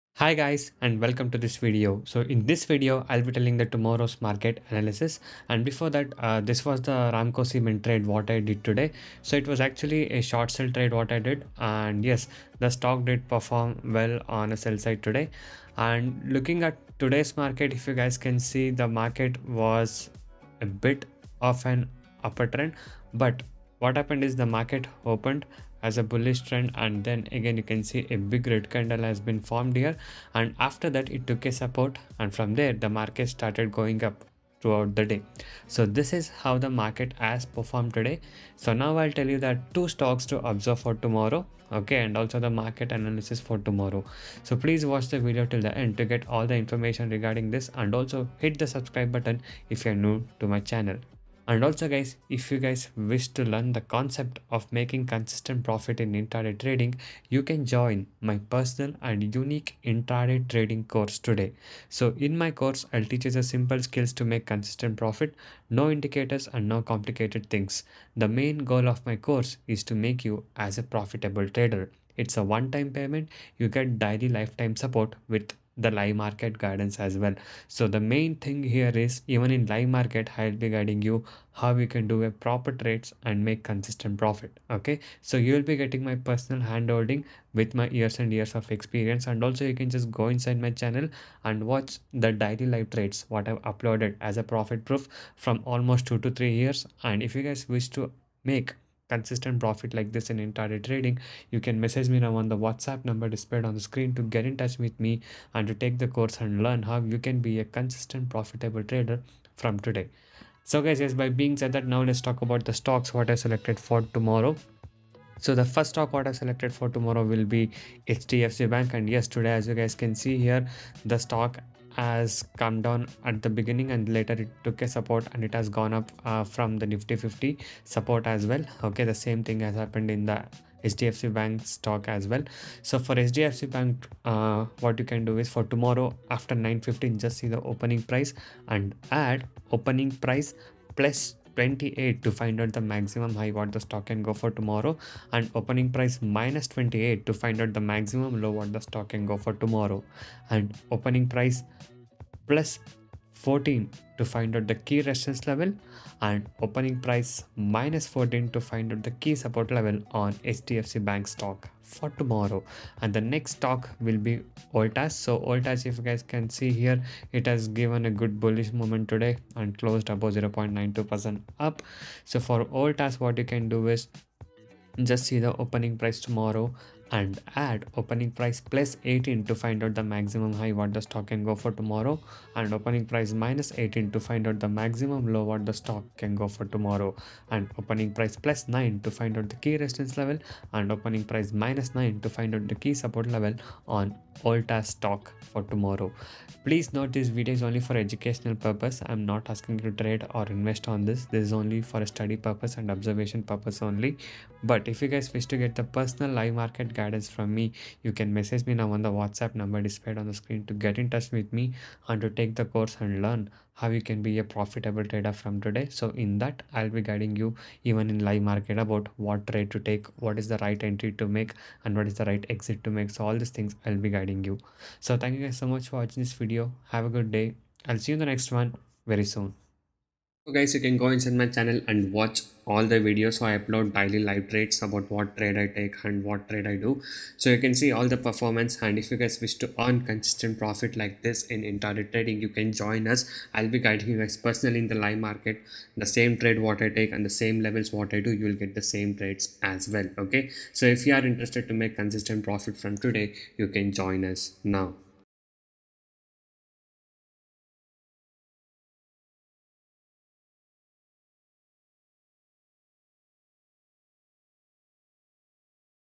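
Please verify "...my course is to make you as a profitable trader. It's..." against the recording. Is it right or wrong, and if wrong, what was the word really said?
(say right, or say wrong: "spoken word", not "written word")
right.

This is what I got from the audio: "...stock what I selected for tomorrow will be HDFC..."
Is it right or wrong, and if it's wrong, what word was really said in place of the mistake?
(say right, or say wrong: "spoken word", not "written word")
right.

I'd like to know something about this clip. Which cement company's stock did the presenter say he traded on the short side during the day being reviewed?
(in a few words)
Ramco Cement.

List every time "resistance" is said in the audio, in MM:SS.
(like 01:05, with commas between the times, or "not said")
02:35, 03:09.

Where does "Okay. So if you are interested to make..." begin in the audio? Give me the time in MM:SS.
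04:10.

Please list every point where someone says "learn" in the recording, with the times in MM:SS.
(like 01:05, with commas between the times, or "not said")
00:53, 01:46, 03:33.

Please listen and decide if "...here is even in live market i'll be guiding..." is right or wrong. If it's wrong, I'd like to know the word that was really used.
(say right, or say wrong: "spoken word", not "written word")
right.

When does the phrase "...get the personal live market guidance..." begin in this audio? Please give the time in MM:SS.
03:25.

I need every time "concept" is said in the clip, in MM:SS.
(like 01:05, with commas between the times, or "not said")
00:53.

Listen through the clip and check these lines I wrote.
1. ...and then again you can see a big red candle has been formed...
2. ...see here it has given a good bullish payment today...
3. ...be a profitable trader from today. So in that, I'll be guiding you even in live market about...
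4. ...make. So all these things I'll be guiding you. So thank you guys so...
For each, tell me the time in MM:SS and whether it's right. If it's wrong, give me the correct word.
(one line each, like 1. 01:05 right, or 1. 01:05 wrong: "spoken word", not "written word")
1. 00:26 right
2. 02:46 wrong: "moment", not "payment"
3. 03:34 right
4. 03:42 right.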